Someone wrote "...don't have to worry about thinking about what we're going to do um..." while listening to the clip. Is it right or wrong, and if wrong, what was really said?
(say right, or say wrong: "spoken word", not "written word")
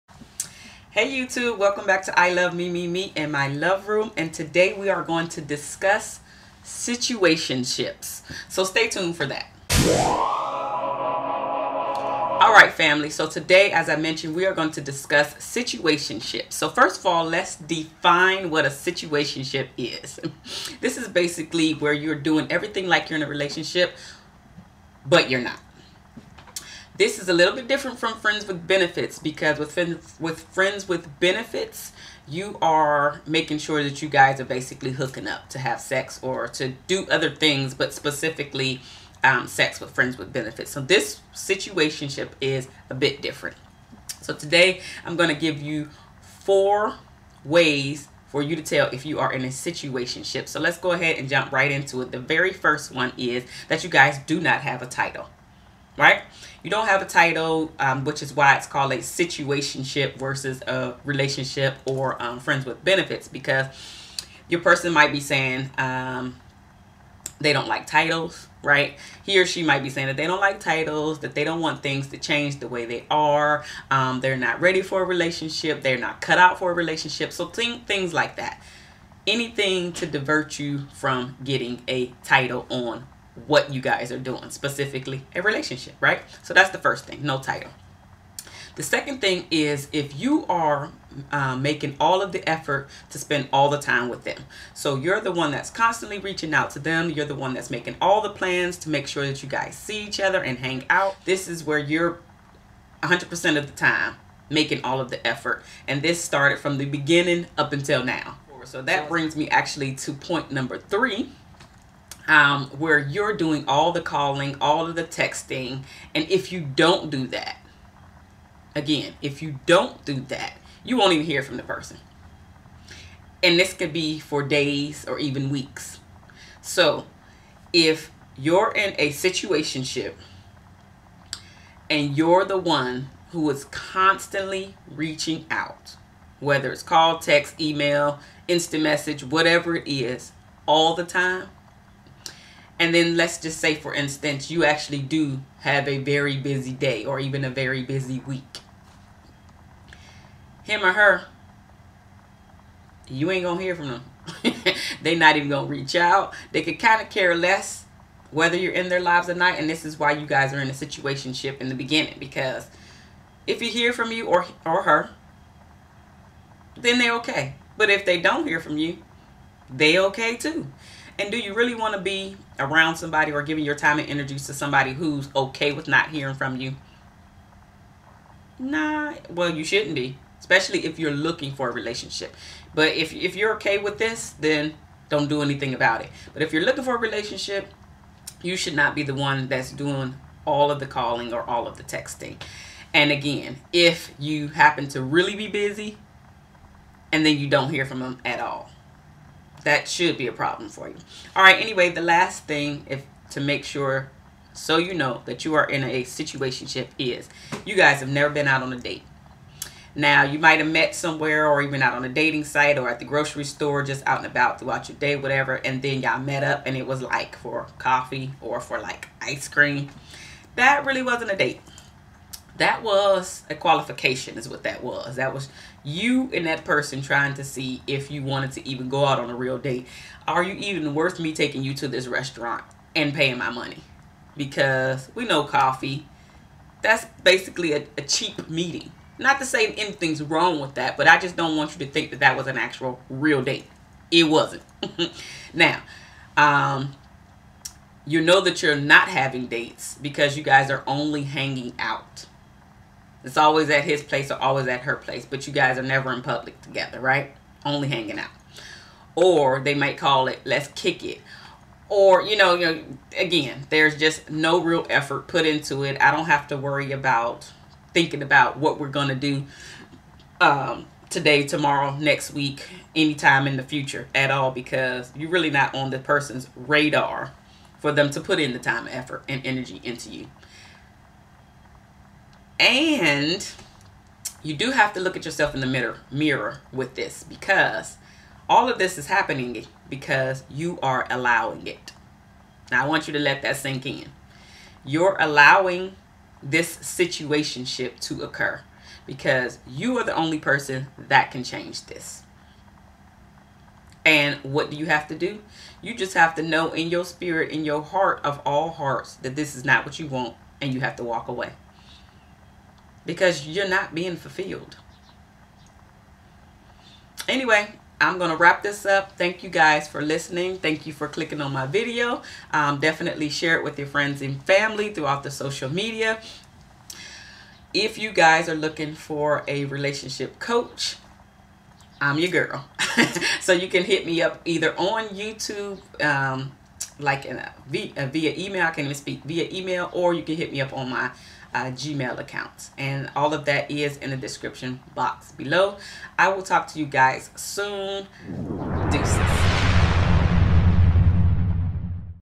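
right.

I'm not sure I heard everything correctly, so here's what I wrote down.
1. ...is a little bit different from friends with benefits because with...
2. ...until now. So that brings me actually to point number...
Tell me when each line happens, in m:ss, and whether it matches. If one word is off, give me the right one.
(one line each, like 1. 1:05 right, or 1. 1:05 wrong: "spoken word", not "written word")
1. 0:27 right
2. 1:47 right.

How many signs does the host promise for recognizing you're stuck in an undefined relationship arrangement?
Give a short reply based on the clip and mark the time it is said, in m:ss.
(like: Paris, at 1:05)
4, at 0:46.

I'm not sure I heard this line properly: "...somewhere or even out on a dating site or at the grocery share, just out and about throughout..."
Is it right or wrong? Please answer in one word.
wrong.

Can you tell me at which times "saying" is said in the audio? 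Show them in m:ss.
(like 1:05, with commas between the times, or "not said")
1:05, 1:09.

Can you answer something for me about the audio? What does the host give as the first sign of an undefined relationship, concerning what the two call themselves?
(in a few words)
No title.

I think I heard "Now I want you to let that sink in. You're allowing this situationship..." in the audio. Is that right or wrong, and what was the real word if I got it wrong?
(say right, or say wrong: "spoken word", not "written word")
right.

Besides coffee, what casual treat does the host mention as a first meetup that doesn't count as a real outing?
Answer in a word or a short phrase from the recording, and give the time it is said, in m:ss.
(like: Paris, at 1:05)
Ice cream, at 3:39.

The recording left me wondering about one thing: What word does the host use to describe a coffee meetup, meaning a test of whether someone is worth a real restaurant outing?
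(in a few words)
Qualification.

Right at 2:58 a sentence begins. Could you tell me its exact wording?
Nah, well, you shouldn't be, especially if you're looking for a relationship.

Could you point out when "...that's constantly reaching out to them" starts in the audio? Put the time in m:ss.
1:35.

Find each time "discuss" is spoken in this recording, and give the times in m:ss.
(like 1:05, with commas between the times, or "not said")
0:05, 0:14.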